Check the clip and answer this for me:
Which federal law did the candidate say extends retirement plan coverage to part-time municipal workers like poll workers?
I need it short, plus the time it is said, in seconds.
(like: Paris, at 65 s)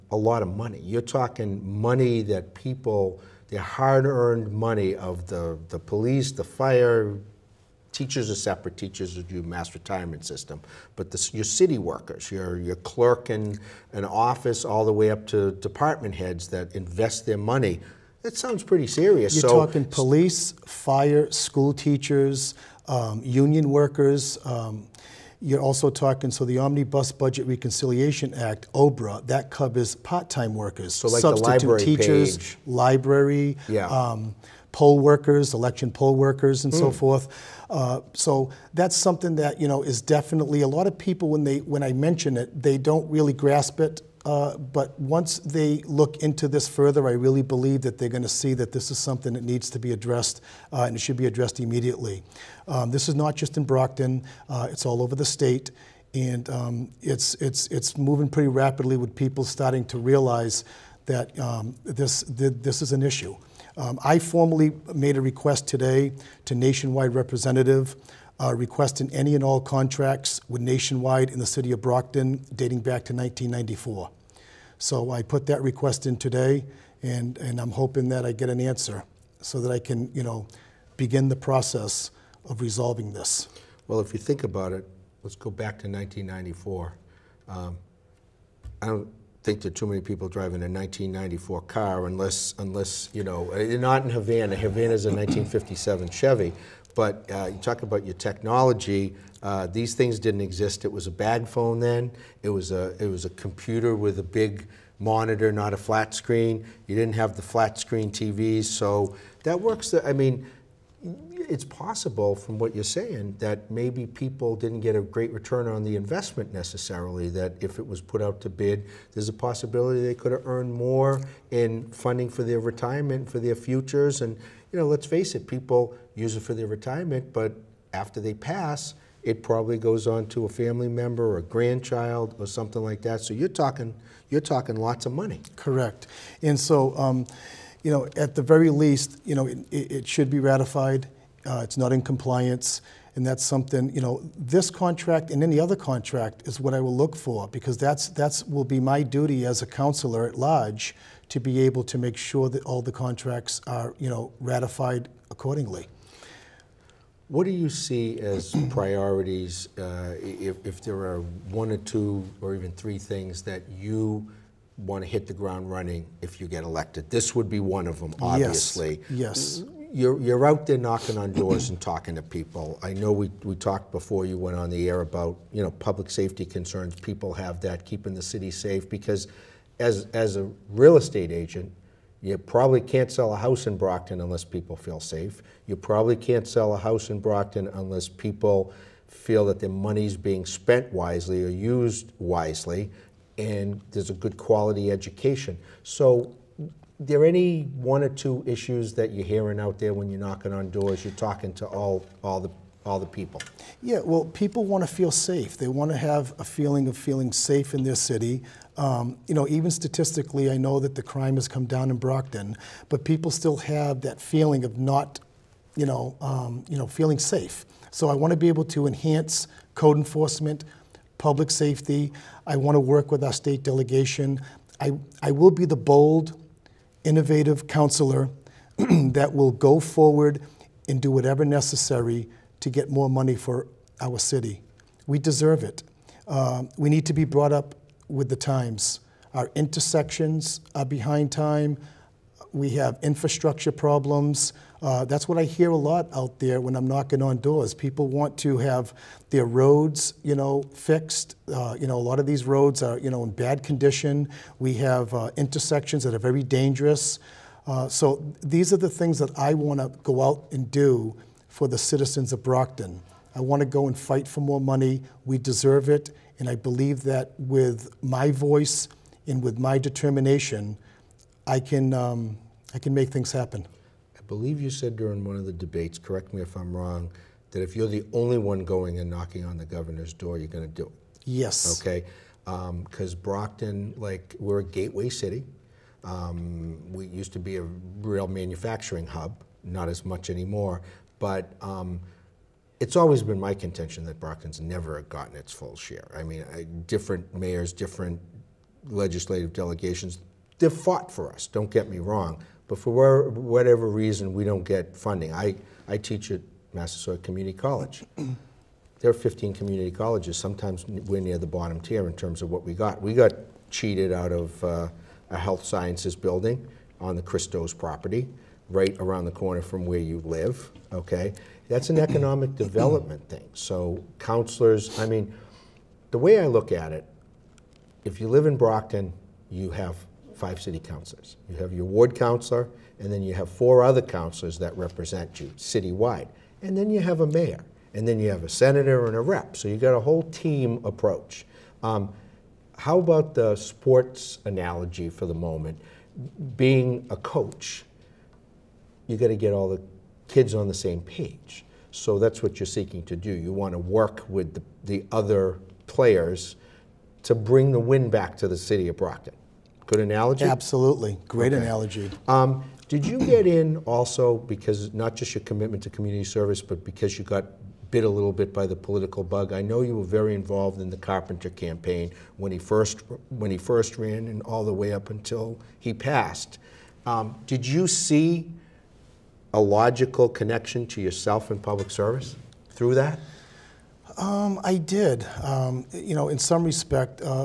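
Omnibus Budget Reconciliation Act, at 26 s.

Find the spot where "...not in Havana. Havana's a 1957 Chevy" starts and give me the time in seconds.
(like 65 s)
93 s.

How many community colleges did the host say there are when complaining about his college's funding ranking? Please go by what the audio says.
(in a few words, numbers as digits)
15.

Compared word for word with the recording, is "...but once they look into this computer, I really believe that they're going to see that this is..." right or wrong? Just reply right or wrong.
wrong.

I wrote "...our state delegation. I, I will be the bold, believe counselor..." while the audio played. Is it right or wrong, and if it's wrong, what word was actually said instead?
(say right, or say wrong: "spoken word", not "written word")
wrong: "innovative", not "believe".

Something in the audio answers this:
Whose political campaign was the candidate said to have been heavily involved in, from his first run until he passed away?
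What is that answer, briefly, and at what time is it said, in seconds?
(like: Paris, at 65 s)
Carpenter, at 370 s.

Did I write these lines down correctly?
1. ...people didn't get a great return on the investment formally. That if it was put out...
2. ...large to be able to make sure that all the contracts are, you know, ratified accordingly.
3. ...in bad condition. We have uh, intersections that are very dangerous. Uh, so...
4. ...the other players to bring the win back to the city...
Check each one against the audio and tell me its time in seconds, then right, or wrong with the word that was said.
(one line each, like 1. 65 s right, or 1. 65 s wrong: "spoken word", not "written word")
1. 114 s wrong: "necessarily", not "formally"
2. 150 s right
3. 253 s right
4. 354 s right.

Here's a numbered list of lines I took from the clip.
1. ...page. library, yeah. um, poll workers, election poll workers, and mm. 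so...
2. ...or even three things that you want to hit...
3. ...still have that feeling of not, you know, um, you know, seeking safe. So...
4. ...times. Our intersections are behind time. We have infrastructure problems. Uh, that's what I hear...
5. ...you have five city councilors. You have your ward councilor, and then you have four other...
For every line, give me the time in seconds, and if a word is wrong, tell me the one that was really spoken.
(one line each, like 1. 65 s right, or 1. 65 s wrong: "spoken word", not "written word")
1. 32 s right
2. 162 s right
3. 213 s wrong: "feeling", not "seeking"
4. 238 s right
5. 329 s right.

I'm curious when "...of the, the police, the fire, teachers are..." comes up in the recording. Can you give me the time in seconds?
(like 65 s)
4 s.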